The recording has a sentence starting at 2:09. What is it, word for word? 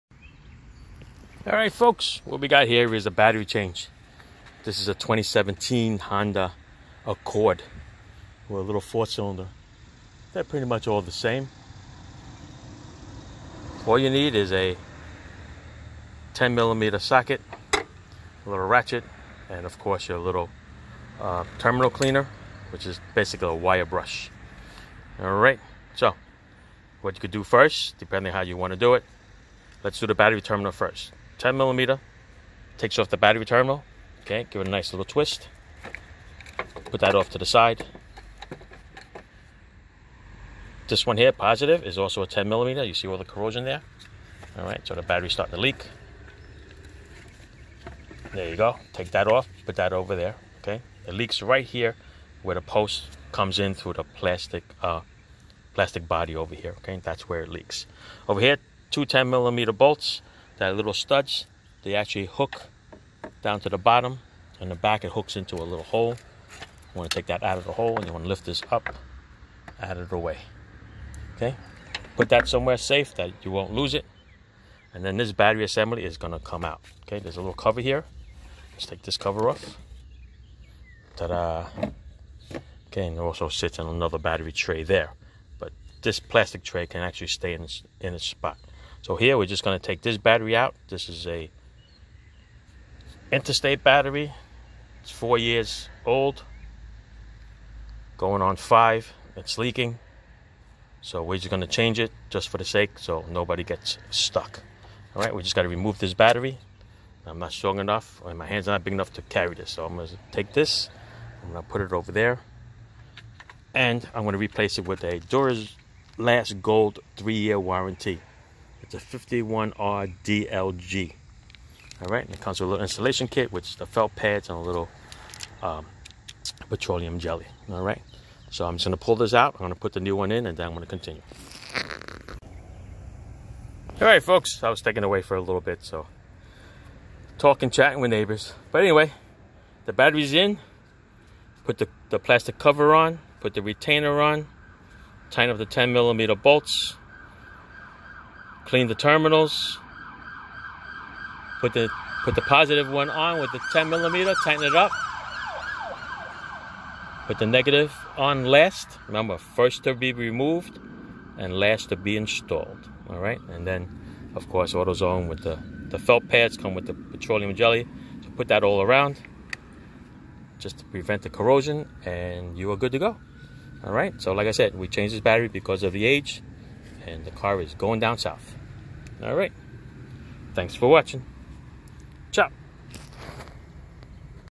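I'm gonna put the new one in, and then I'm gonna continue.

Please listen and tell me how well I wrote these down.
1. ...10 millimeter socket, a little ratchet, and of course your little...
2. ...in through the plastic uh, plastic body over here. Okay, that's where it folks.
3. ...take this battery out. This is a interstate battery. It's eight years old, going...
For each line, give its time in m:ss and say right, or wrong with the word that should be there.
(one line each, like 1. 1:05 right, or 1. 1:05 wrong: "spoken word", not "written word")
1. 0:16 right
2. 0:53 wrong: "leaks", not "folks"
3. 1:29 wrong: "four", not "eight".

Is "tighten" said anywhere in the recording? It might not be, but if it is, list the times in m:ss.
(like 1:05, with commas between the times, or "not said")
2:25, 2:34.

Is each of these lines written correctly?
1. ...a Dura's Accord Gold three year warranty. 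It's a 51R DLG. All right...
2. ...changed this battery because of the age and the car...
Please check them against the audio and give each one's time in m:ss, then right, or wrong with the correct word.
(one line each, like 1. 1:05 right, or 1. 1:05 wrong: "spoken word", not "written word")
1. 1:55 wrong: "Last", not "Accord"
2. 2:54 right.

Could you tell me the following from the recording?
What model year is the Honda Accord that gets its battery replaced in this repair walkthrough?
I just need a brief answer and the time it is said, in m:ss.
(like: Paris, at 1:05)
2017, at 0:04.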